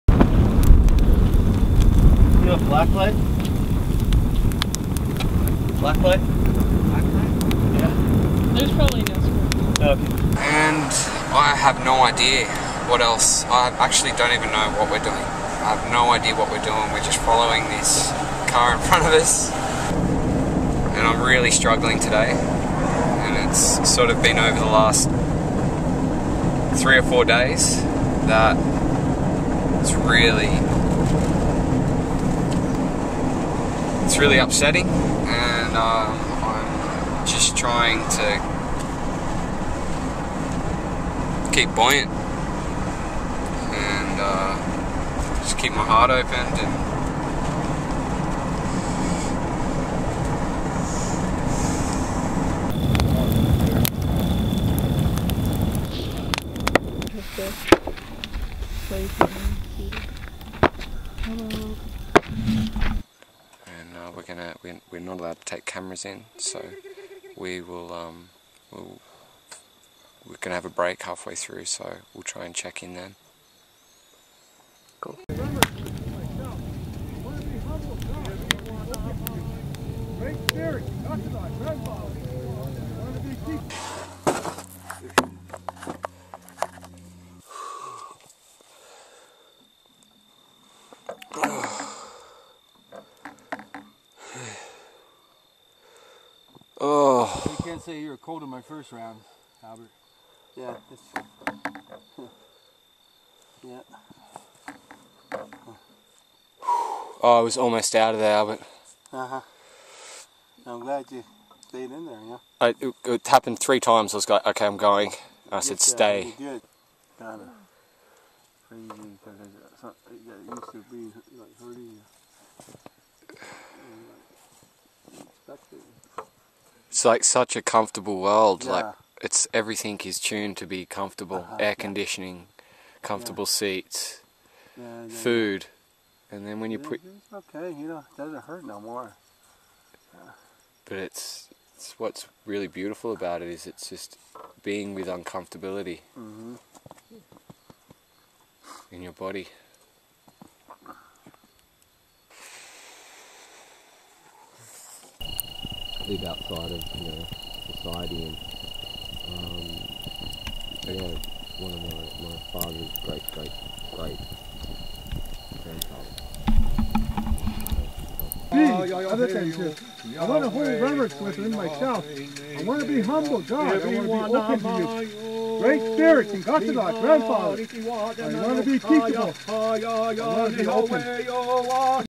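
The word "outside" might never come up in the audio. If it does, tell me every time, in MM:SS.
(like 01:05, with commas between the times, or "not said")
02:36.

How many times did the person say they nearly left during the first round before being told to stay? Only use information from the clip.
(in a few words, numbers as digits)
3 times.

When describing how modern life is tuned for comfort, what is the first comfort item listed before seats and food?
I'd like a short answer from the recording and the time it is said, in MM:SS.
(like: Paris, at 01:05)
Air conditioning, at 02:11.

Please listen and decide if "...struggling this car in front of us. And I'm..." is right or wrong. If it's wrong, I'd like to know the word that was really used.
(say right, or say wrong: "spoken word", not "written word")
wrong: "following", not "struggling".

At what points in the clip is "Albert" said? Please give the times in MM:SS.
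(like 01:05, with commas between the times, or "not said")
01:39, 01:48.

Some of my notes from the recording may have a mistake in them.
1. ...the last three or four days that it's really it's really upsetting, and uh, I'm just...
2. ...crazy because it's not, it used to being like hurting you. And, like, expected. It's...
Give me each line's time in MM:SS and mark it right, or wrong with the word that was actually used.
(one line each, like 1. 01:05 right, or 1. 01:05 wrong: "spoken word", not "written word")
1. 00:24 right
2. 01:58 right.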